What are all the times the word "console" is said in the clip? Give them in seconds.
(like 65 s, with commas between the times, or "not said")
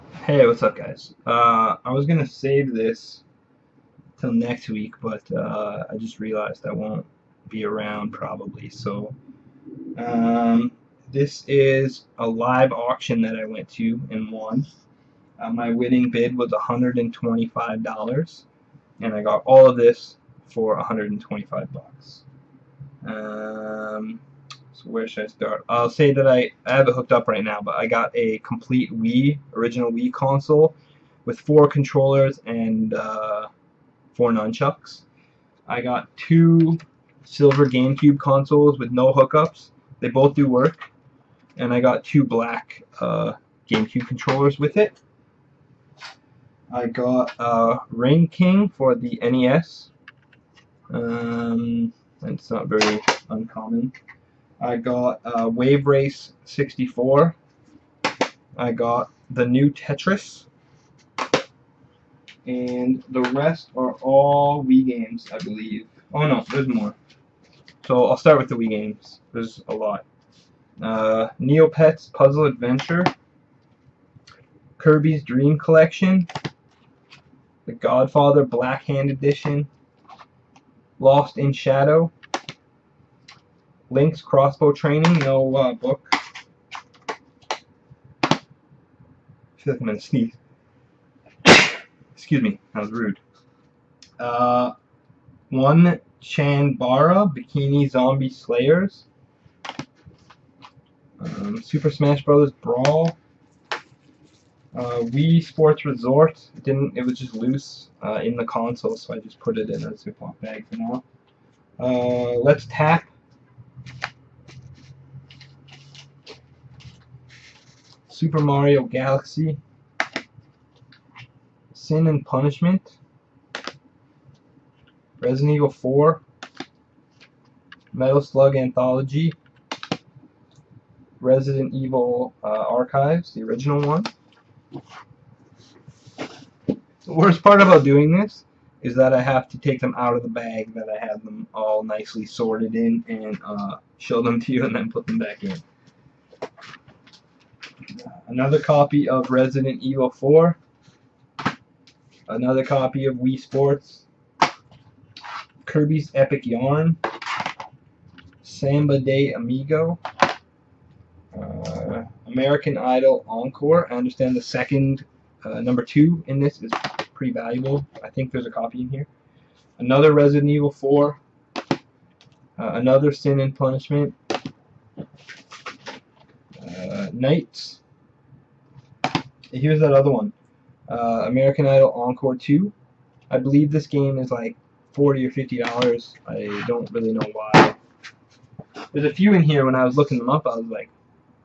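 30 s, 38 s, 108 s.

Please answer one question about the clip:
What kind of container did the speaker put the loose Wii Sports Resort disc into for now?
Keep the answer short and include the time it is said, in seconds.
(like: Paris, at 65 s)
Ziploc bag, at 109 s.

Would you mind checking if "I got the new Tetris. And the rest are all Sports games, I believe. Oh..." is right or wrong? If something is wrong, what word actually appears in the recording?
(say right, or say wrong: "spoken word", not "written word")
wrong: "Wii", not "Sports".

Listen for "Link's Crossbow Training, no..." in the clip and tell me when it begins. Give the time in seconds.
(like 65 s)
83 s.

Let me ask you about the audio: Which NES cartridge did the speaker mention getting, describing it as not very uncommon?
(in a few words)
Rain King.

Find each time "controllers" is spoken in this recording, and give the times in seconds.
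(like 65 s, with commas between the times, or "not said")
31 s, 44 s.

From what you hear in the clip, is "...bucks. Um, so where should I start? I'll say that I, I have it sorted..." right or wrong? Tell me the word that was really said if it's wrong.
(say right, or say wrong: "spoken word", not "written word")
wrong: "hooked", not "sorted".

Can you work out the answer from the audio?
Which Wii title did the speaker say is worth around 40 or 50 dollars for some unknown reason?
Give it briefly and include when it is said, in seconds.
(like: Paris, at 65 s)
American Idol Encore 2, at 181 s.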